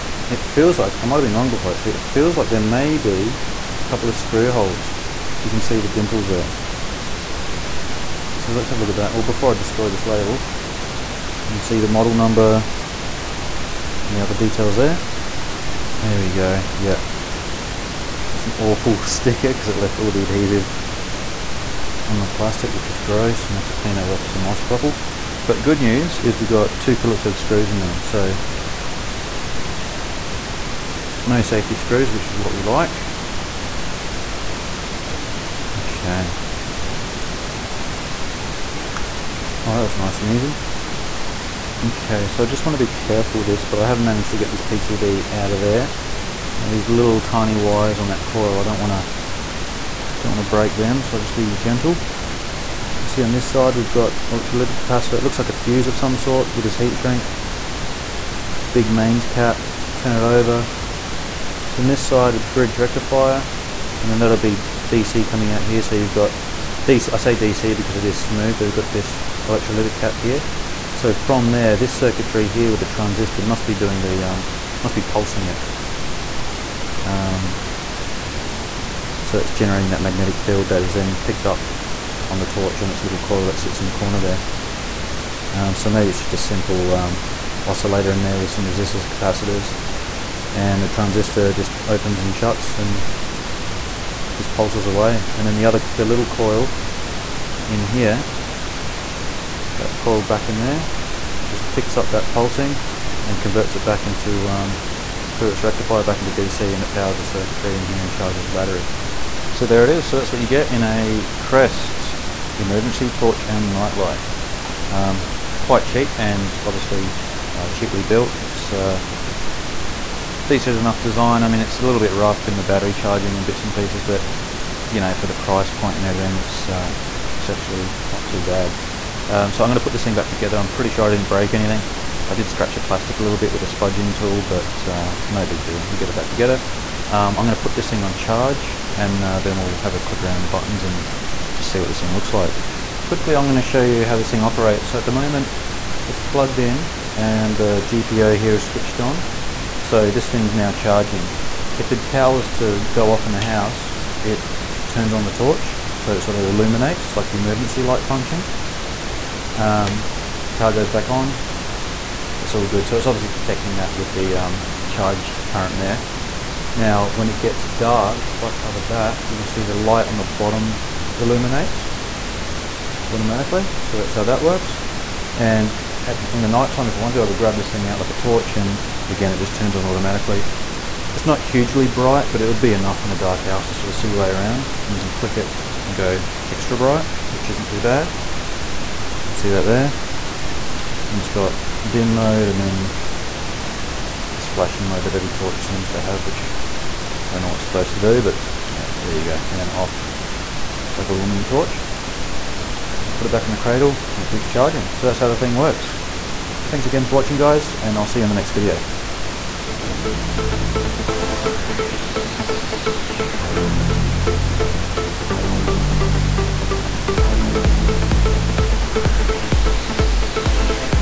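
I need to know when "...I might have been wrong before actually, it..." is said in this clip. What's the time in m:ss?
0:01.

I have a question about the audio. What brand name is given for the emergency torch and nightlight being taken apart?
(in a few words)
Crest.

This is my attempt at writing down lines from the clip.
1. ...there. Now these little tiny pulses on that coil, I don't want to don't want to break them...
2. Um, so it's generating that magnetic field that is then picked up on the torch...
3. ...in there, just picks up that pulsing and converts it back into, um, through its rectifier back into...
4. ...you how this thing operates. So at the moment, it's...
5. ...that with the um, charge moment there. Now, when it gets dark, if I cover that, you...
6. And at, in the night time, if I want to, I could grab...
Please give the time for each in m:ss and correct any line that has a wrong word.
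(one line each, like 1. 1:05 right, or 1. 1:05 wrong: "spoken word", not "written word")
1. 0:45 wrong: "wires", not "pulses"
2. 1:17 right
3. 1:40 right
4. 2:23 right
5. 2:43 wrong: "current", not "moment"
6. 2:55 right.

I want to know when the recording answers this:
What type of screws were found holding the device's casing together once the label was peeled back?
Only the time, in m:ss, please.
0:26.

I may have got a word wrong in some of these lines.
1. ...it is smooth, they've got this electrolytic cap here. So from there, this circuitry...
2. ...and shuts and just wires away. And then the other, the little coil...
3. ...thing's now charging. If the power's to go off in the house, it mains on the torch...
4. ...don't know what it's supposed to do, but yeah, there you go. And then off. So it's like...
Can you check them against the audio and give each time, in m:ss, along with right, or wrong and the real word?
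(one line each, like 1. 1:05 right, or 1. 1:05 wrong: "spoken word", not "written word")
1. 1:07 right
2. 1:32 wrong: "pulses", not "wires"
3. 2:30 wrong: "turns", not "mains"
4. 3:17 right.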